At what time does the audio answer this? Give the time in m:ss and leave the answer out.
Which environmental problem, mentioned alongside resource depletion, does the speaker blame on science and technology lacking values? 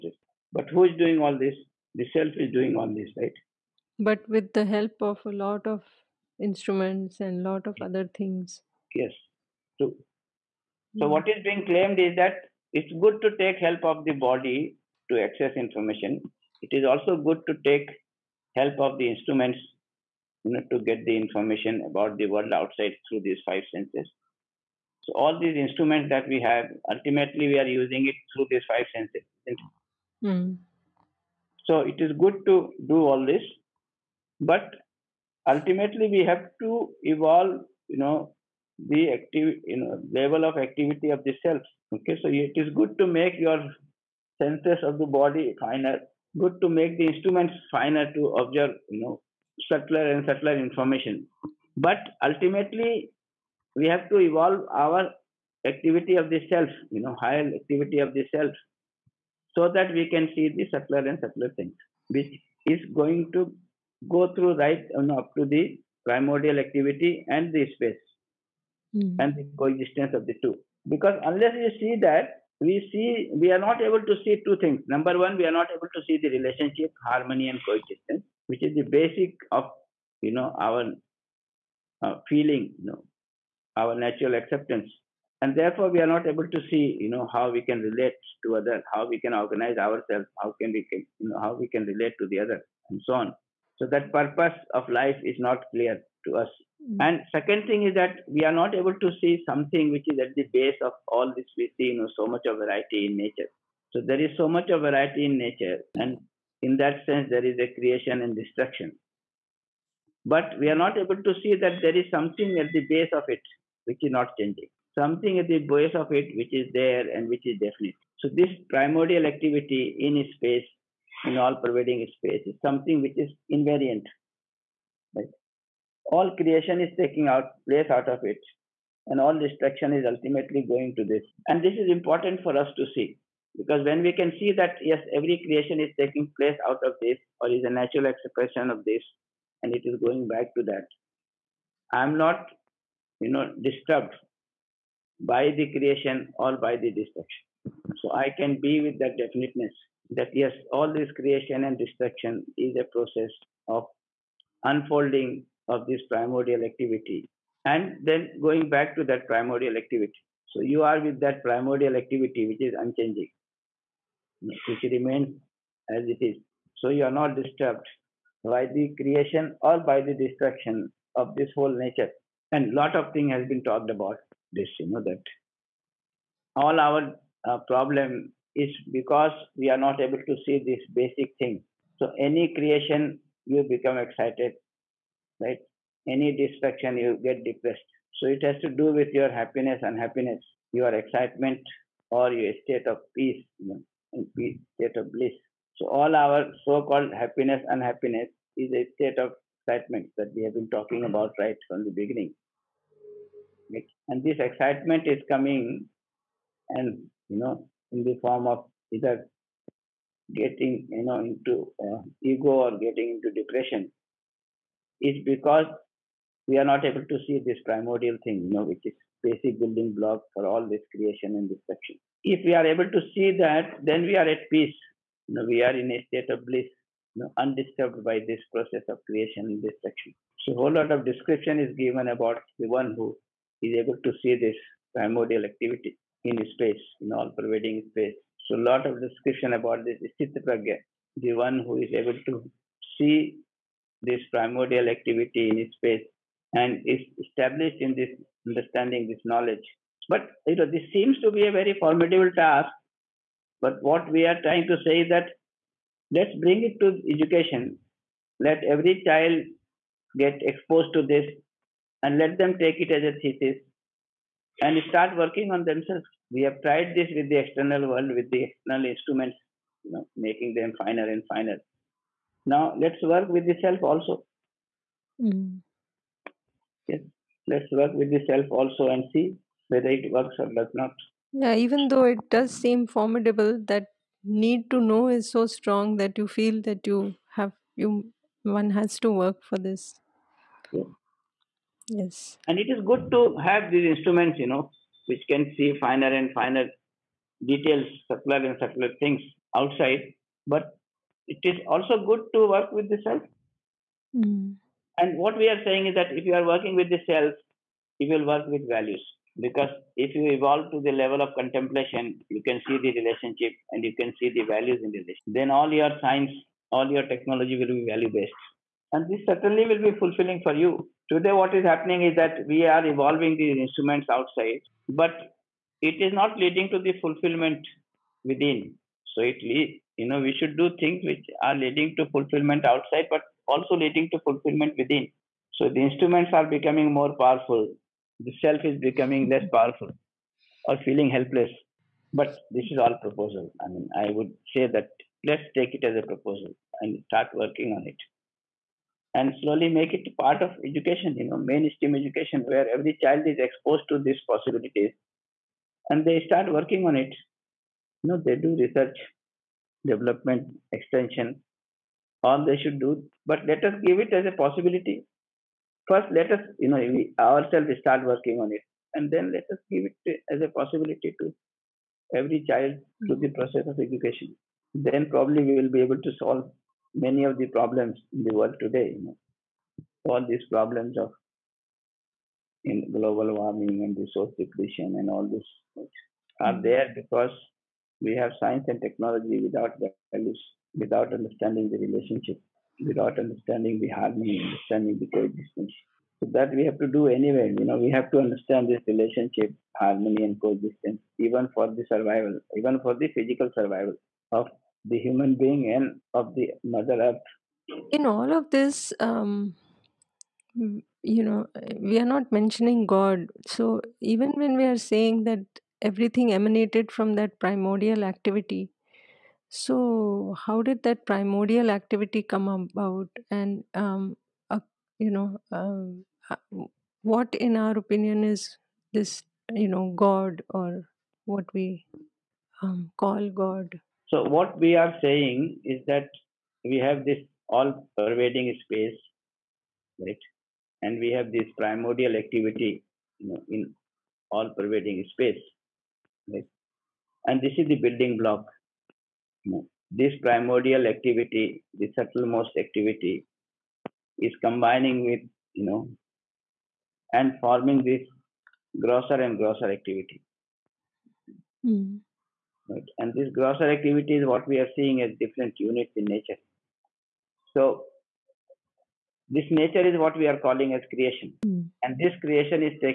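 6:22.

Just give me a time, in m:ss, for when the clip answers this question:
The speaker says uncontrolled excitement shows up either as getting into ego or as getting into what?
3:33.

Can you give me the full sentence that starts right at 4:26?
We have tried this with the external world, with the external instruments, you know, making them finer and finer.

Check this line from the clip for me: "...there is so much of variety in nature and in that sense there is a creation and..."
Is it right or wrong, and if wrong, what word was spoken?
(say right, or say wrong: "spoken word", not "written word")
right.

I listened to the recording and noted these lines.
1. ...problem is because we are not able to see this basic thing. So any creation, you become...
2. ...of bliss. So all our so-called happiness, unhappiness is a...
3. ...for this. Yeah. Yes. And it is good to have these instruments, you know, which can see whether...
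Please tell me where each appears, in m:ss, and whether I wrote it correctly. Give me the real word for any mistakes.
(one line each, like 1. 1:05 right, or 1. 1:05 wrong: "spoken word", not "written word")
1. 2:57 right
2. 3:14 right
3. 4:49 wrong: "finer", not "whether".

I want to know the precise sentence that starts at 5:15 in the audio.
Then all your science, all your technology will be value based and this certainly will be fulfilling for you.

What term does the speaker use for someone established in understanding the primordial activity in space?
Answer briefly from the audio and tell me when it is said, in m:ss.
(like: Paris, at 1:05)
Sthitpragya, at 4:00.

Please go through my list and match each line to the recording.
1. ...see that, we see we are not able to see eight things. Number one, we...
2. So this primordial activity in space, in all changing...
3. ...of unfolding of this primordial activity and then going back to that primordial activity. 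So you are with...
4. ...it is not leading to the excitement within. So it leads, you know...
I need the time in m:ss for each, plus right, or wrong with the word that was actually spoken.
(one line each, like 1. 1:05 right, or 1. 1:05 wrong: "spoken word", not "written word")
1. 1:11 wrong: "two", not "eight"
2. 1:58 wrong: "pervading", not "changing"
3. 2:33 right
4. 5:25 wrong: "fulfillment", not "excitement".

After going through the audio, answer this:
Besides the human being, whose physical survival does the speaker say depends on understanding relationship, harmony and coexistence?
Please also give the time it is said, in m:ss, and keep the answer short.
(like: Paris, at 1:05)
Mother Earth, at 6:46.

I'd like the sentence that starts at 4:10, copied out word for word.
But you know, this seems to be a very formidable task.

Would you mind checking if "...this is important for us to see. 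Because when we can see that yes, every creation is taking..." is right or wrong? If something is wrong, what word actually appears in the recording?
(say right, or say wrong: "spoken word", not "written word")
right.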